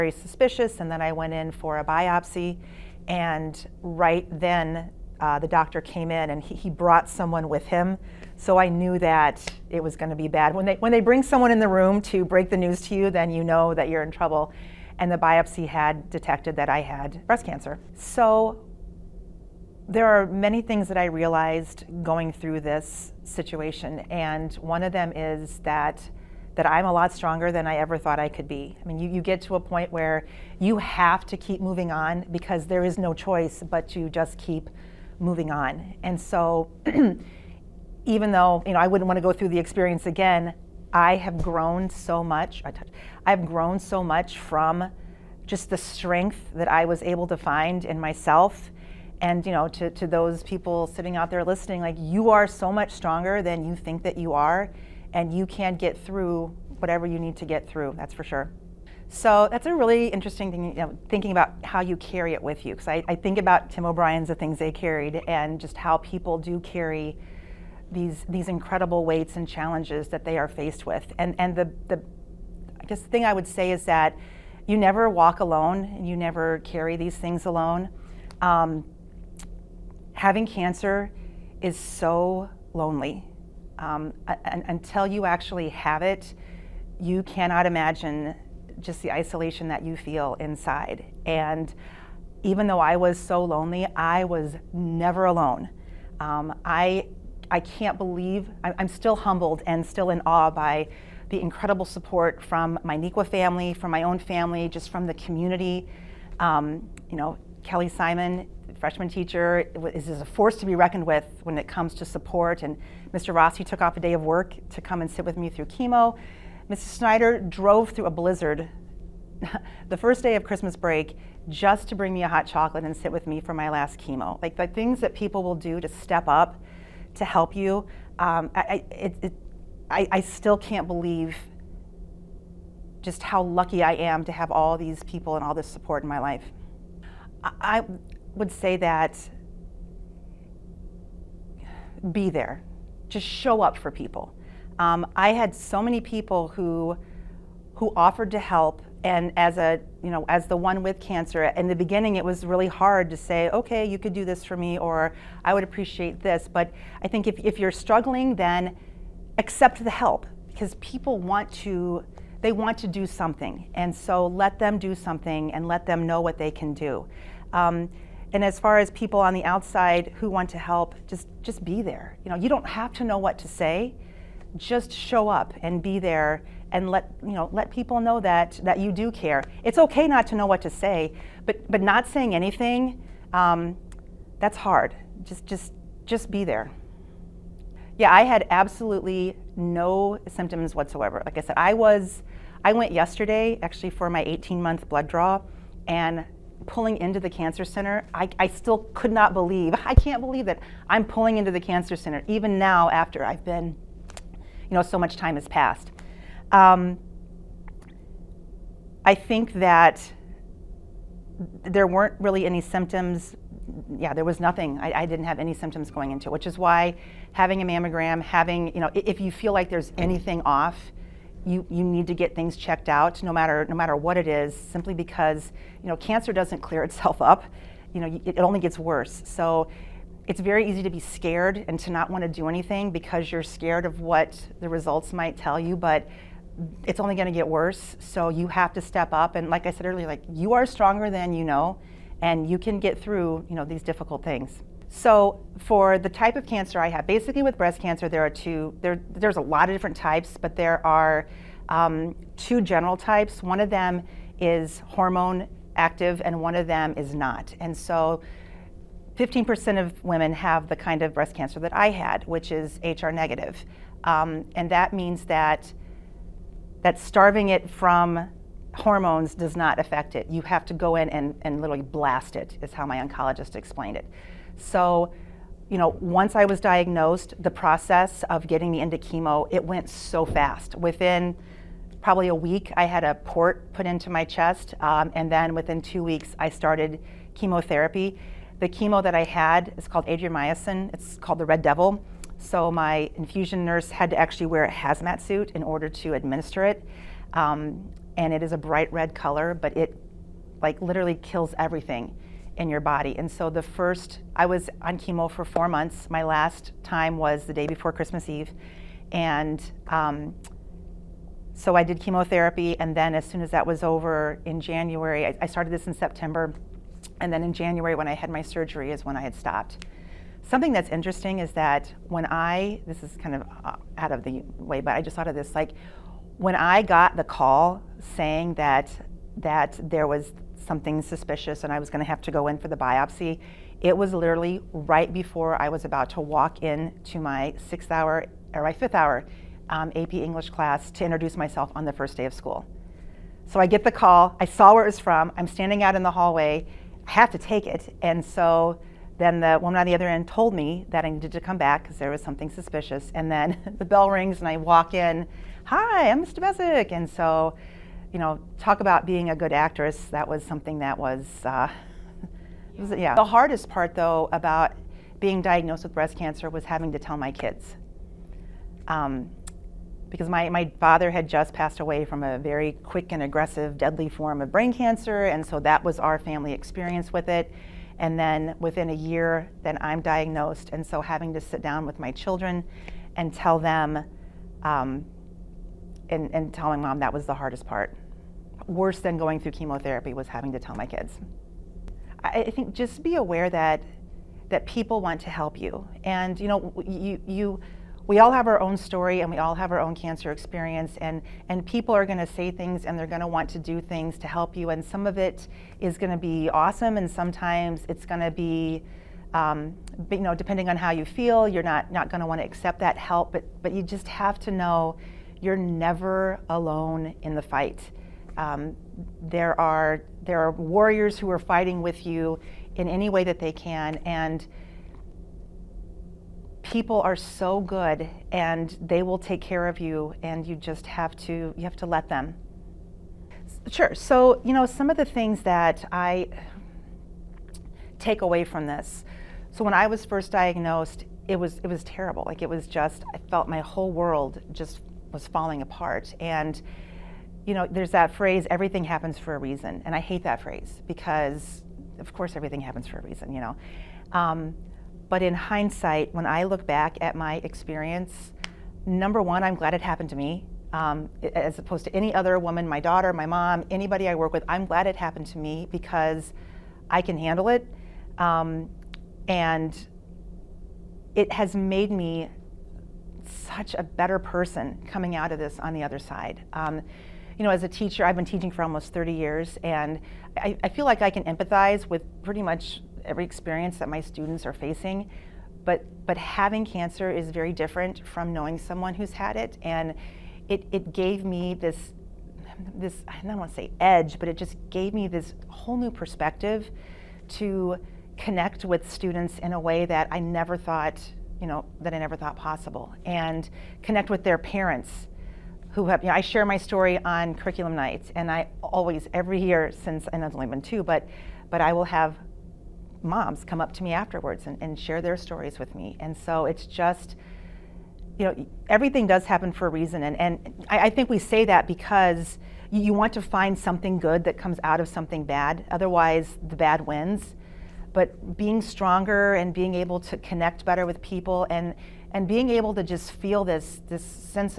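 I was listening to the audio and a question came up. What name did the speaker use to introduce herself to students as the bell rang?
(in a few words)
Ms. Dabezic.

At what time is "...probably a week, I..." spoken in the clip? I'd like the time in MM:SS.
04:41.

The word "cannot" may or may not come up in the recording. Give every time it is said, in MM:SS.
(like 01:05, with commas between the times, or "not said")
01:27.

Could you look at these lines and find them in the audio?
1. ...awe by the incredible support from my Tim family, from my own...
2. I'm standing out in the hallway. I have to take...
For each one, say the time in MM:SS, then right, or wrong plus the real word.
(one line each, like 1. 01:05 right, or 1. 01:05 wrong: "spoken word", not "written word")
1. 01:40 wrong: "Neuqua", not "Tim"
2. 05:45 right.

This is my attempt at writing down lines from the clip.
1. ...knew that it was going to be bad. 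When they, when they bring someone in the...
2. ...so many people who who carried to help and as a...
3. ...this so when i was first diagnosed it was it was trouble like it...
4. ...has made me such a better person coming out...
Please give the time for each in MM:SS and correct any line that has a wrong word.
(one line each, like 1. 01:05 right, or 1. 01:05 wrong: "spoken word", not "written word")
1. 00:08 right
2. 02:25 wrong: "offered", not "carried"
3. 07:18 wrong: "terrible", not "trouble"
4. 07:51 right.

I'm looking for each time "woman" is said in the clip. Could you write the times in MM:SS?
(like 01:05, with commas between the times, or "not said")
05:49, 07:42.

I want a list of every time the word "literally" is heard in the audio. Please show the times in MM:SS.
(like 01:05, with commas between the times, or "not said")
04:31, 05:00, 05:34.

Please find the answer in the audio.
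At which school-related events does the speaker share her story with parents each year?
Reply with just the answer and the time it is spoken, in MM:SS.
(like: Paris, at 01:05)
Curriculum nights, at 08:27.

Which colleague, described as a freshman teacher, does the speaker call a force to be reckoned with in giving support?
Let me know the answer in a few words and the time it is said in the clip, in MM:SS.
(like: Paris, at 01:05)
Kelly Simon, at 01:47.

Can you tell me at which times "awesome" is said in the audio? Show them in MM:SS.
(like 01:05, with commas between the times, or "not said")
06:46.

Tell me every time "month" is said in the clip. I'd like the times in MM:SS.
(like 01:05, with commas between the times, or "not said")
03:14, 05:05.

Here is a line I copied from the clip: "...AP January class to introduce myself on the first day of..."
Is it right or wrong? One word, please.
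wrong.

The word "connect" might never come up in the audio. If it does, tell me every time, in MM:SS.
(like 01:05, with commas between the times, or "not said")
08:18, 08:23, 08:50.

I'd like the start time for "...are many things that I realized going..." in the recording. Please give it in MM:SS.
00:20.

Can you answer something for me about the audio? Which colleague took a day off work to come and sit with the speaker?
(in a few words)
Mr. Rossi.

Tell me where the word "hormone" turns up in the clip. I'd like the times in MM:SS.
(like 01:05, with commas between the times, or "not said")
04:14, 04:28.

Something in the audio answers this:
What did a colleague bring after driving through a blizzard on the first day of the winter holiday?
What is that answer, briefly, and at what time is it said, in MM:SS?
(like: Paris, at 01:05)
Hot chocolate, at 02:02.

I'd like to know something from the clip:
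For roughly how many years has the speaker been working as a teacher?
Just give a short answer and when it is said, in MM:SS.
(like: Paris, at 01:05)
Almost 30 years, at 07:58.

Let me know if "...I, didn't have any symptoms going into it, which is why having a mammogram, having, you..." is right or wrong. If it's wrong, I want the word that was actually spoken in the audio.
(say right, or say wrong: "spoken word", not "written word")
right.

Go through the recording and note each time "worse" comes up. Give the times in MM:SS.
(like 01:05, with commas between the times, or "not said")
03:48, 03:57, 06:28.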